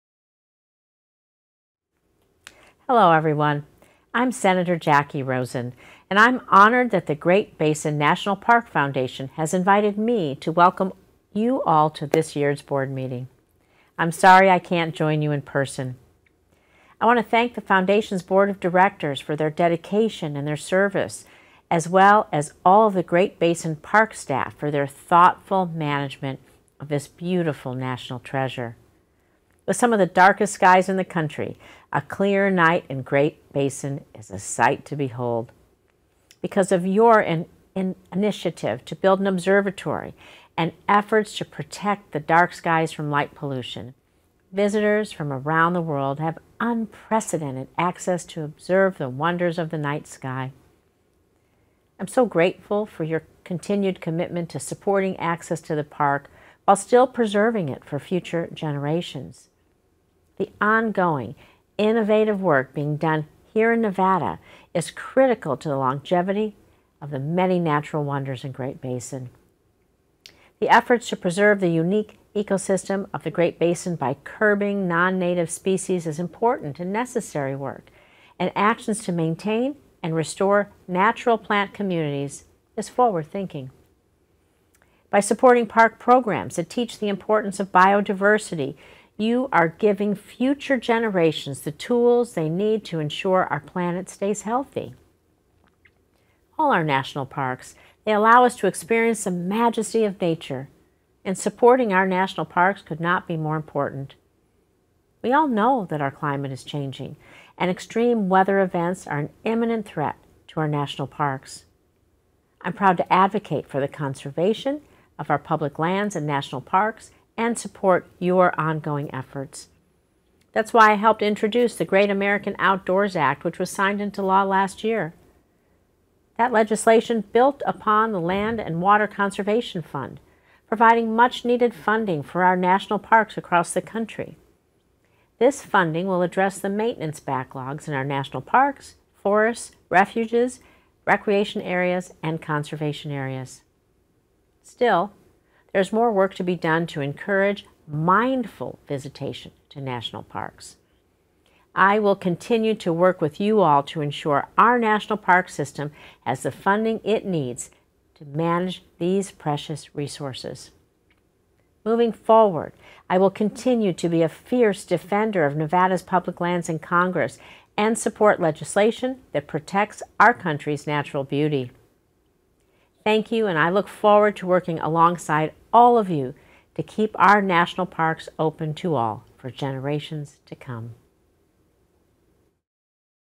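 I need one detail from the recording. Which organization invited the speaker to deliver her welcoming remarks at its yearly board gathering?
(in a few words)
Great Basin National Park Foundation.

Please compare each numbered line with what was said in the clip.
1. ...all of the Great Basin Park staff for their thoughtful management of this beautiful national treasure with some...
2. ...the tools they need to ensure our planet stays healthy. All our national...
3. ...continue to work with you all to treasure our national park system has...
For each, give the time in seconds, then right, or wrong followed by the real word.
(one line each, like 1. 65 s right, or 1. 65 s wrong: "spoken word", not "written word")
1. 22 s right
2. 91 s right
3. 152 s wrong: "ensure", not "treasure".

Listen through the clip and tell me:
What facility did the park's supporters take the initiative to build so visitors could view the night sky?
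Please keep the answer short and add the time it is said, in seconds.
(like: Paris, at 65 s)
An observatory, at 39 s.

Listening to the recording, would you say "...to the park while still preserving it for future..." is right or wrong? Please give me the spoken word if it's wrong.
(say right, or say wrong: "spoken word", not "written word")
right.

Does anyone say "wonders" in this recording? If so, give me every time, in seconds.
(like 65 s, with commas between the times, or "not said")
49 s, 68 s.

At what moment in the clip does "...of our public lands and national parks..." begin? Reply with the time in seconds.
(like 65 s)
115 s.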